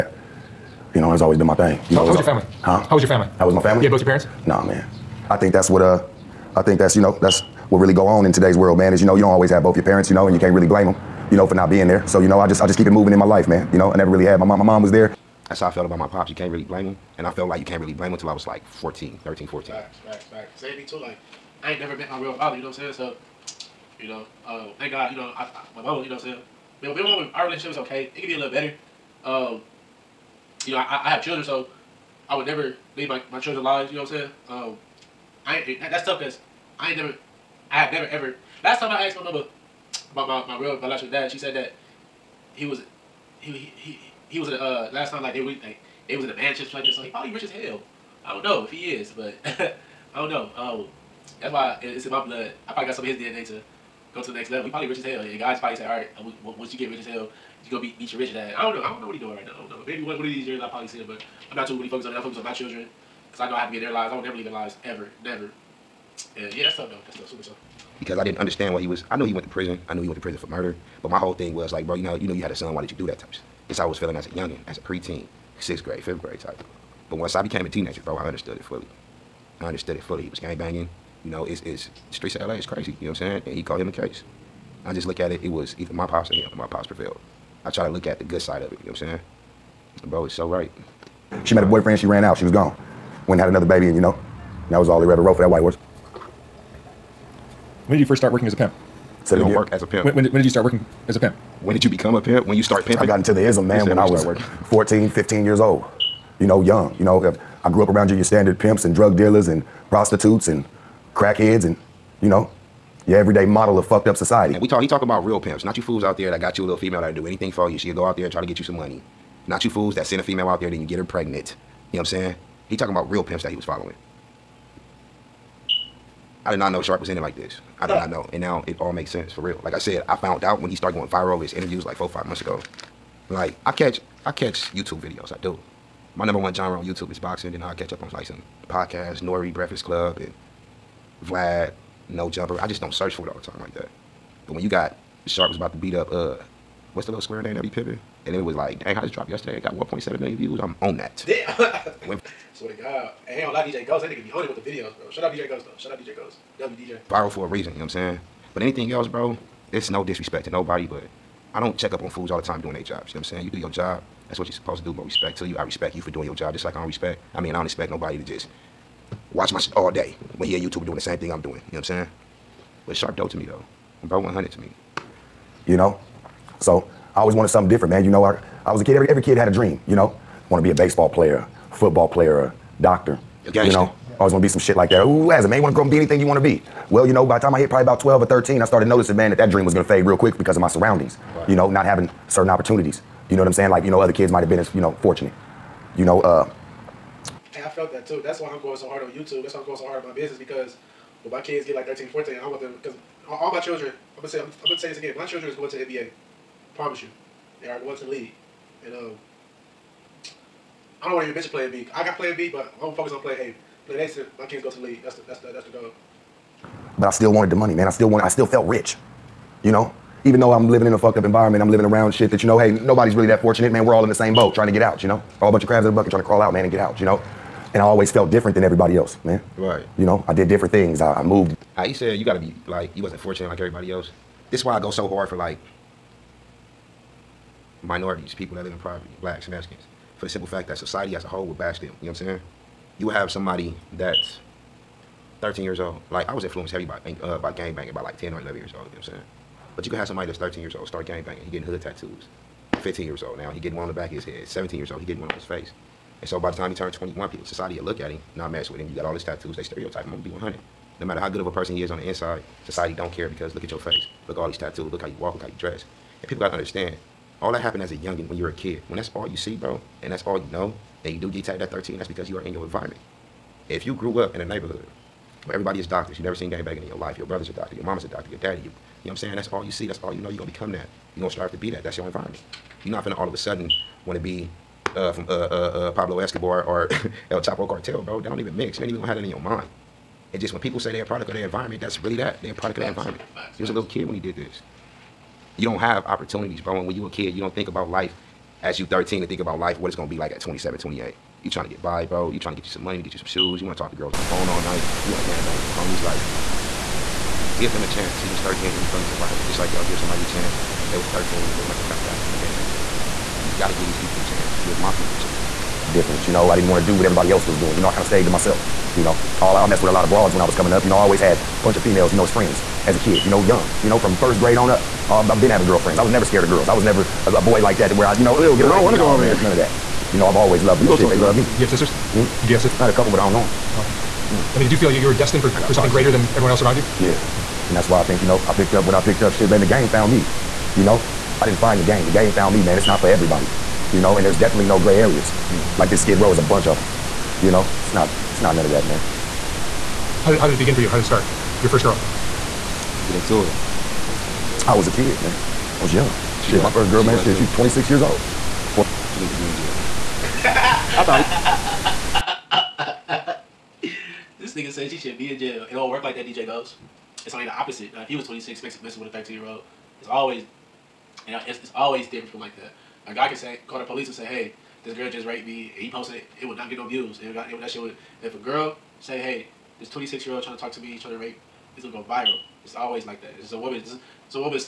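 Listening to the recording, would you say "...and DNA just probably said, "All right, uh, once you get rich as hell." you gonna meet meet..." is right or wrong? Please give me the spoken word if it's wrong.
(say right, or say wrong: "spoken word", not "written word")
wrong: "God", not "DNA".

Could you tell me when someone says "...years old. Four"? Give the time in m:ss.
5:57.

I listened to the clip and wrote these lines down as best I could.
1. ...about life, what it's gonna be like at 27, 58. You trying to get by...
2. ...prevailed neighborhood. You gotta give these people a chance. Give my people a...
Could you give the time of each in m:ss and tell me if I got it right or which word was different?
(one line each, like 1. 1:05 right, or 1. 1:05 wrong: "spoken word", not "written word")
1. 4:59 wrong: "28", not "58"
2. 5:12 wrong: "gated", not "prevailed".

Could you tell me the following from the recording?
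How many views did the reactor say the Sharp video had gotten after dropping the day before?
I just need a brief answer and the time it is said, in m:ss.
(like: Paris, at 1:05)
1.7 million, at 2:29.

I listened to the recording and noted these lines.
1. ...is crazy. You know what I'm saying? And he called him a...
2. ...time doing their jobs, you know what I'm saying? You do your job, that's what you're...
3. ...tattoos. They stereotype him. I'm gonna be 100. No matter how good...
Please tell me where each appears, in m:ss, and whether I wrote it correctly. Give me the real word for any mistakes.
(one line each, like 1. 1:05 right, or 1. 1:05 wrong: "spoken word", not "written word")
1. 1:22 right
2. 2:42 right
3. 4:19 right.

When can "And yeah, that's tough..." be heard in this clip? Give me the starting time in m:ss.
1:06.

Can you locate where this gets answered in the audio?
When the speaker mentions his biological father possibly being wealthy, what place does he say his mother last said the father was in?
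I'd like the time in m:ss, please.
0:46.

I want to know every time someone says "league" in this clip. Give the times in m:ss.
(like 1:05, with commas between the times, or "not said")
3:28, 3:34.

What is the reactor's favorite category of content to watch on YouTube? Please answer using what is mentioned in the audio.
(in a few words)
Boxing.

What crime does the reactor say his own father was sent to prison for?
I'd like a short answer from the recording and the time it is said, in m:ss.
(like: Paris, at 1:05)
Murder, at 1:10.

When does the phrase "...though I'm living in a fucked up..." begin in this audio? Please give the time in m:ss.
3:40.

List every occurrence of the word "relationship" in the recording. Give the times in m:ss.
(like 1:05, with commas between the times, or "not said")
0:27.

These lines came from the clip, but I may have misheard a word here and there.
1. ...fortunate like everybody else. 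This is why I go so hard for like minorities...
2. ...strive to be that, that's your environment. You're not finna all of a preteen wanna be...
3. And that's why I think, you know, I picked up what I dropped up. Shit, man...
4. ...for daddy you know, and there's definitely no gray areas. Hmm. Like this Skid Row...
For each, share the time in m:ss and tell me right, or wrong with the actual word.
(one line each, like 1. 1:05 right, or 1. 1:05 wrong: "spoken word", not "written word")
1. 3:53 right
2. 4:41 wrong: "sudden", not "preteen"
3. 5:37 wrong: "picked", not "dropped"
4. 5:43 wrong: "everybody", not "daddy".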